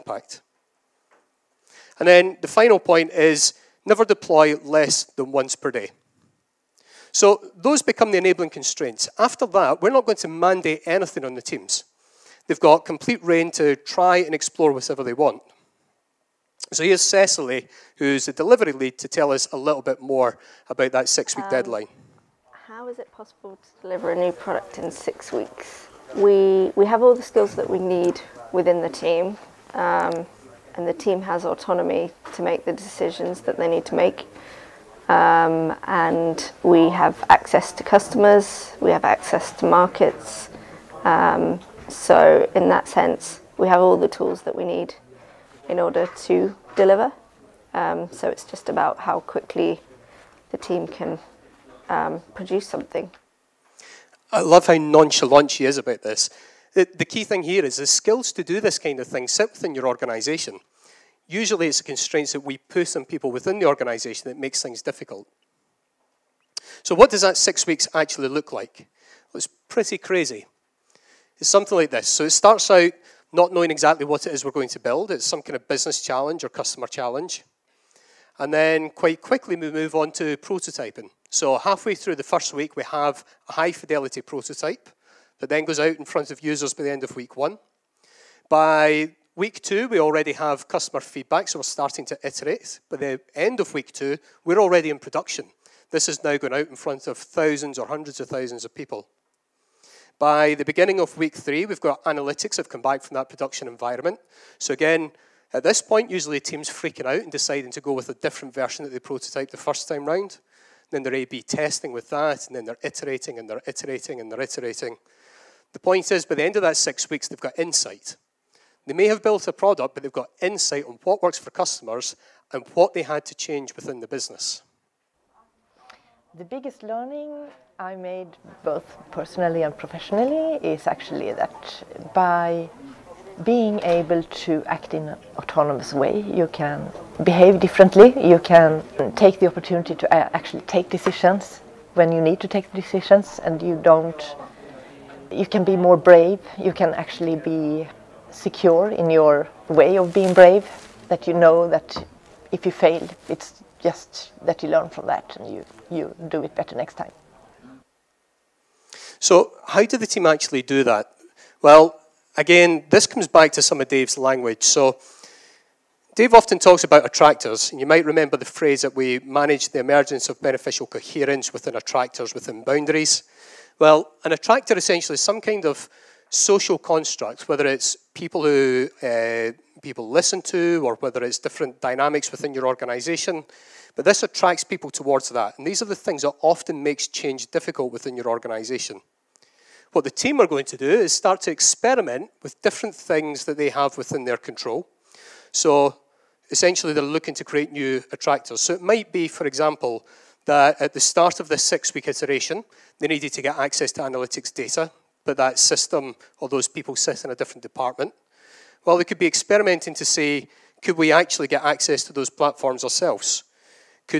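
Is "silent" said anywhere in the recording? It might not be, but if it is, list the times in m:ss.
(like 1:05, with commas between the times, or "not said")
not said.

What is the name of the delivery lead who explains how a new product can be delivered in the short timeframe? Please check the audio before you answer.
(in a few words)
Cecily.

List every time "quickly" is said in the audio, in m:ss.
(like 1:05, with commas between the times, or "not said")
0:49, 1:19.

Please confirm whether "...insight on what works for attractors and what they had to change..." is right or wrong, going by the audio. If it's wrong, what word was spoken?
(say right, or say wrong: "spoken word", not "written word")
wrong: "customers", not "attractors".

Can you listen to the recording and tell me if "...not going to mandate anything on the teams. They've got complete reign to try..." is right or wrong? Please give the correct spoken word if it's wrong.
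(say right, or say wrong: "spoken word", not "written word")
right.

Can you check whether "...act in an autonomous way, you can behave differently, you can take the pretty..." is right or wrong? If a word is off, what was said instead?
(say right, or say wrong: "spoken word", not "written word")
wrong: "opportunity", not "pretty".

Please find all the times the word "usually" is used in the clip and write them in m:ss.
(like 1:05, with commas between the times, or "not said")
1:01, 1:46.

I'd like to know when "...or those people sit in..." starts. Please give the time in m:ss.
3:26.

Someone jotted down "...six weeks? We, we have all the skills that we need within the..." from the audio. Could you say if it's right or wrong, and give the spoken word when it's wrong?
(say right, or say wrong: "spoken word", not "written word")
right.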